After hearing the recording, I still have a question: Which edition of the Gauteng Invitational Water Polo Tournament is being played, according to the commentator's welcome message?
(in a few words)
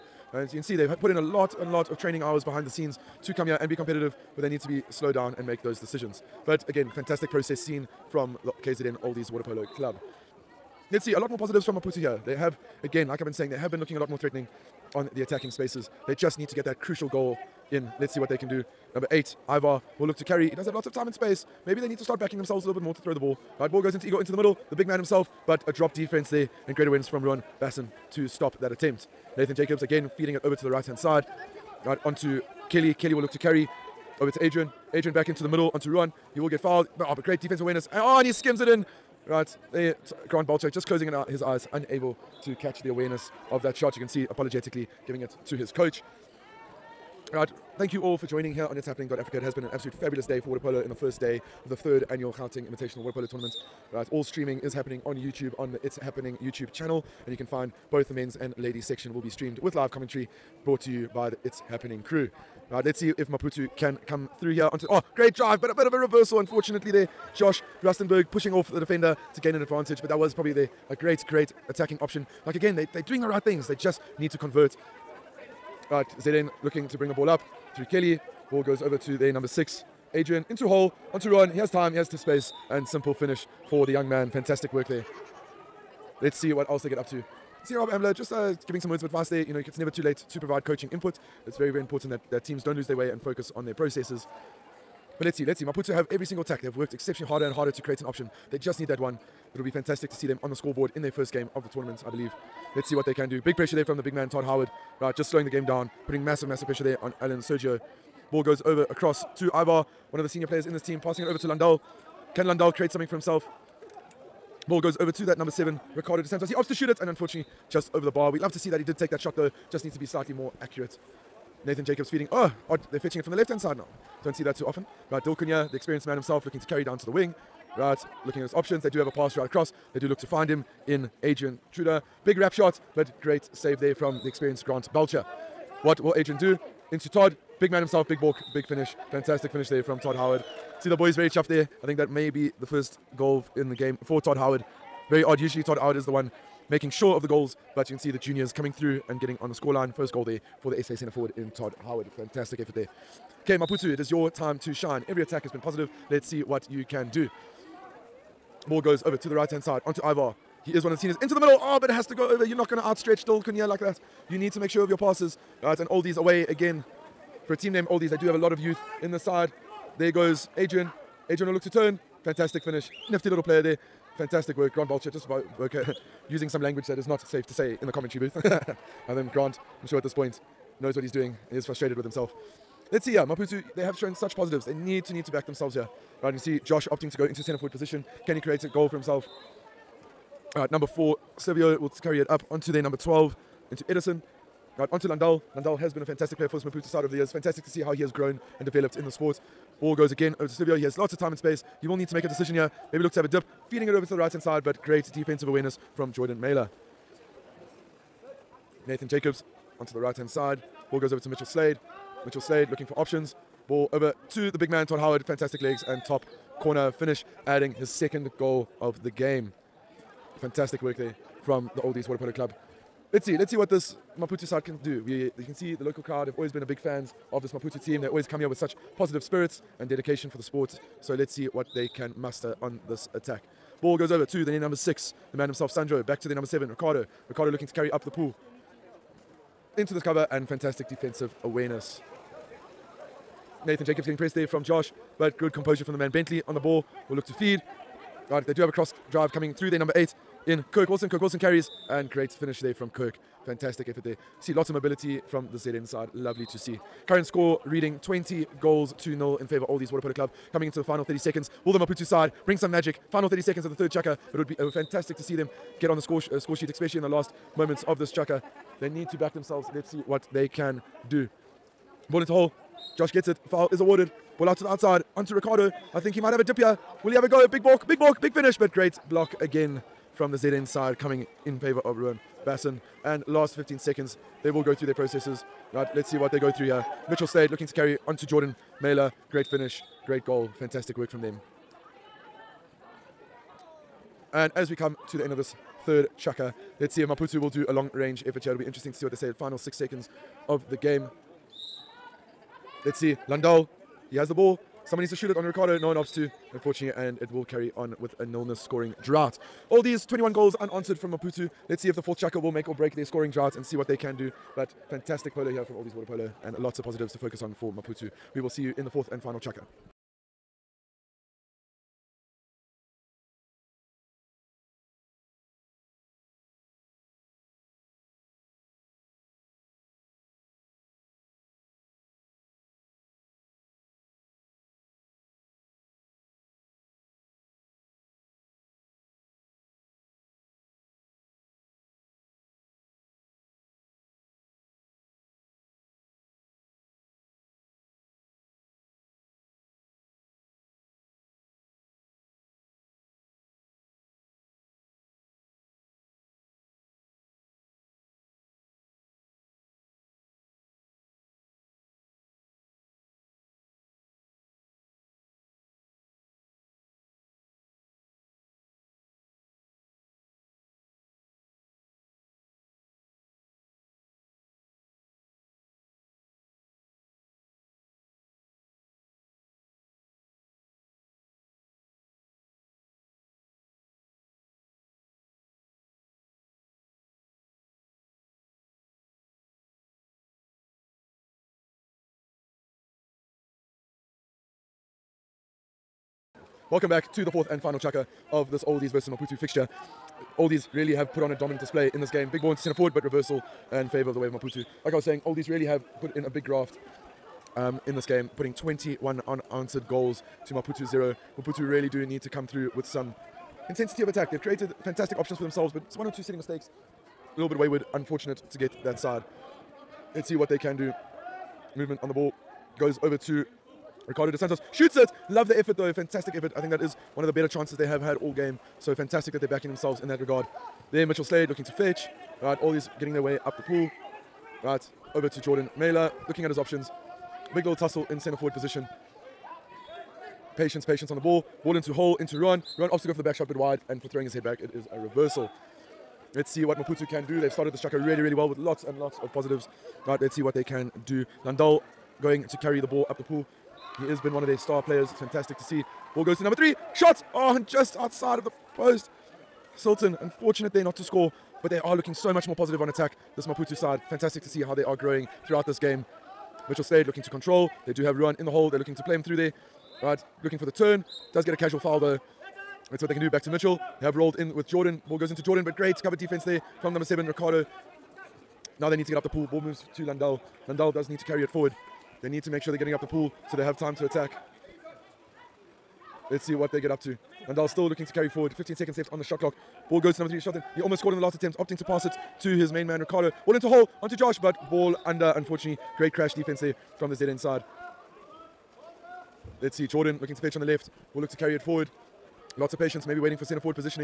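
third annual.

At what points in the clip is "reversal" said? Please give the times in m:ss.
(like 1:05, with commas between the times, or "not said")
1:05, 6:43, 7:24.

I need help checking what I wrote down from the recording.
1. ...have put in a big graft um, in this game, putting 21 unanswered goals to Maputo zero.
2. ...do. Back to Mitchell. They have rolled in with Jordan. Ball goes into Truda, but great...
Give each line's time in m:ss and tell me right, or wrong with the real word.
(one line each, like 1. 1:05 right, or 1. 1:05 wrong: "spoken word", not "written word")
1. 6:45 right
2. 7:53 wrong: "Jordan", not "Truda".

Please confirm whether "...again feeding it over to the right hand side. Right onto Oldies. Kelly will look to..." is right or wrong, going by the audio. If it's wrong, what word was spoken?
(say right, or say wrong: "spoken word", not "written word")
wrong: "Kelly", not "Oldies".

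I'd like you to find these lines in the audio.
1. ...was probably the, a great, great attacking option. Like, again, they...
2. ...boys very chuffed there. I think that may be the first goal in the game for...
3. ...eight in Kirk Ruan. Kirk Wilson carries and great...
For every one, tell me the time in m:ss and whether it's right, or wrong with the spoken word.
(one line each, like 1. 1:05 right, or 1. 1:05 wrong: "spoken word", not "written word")
1. 1:10 right
2. 2:20 right
3. 4:09 wrong: "Wilson", not "Ruan".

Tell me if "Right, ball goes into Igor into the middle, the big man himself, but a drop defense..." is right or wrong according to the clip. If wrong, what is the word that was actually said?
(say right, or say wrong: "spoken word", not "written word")
right.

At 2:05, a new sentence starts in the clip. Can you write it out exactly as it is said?
Right, Dilkunya, the experienced man himself, looking to carry down to the wing.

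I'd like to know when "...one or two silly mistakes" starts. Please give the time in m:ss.
6:55.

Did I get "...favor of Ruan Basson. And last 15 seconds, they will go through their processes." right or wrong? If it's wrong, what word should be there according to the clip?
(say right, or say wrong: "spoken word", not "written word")
right.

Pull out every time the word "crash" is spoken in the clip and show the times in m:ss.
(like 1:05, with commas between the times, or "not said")
8:16.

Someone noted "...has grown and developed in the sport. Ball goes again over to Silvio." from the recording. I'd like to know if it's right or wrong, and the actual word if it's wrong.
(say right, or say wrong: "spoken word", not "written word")
right.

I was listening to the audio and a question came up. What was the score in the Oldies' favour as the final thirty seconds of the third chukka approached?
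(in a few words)
20-0.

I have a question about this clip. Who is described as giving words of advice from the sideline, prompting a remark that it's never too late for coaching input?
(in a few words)
Rob Ambler.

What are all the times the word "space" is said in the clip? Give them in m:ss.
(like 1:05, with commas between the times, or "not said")
0:15, 0:21, 1:22, 3:21.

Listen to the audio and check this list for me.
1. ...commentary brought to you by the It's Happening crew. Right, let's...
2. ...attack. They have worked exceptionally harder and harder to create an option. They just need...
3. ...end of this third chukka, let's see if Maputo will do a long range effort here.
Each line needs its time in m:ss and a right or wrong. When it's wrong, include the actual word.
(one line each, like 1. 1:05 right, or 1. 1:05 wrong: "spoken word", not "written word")
1. 0:59 right
2. 1:36 right
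3. 4:55 right.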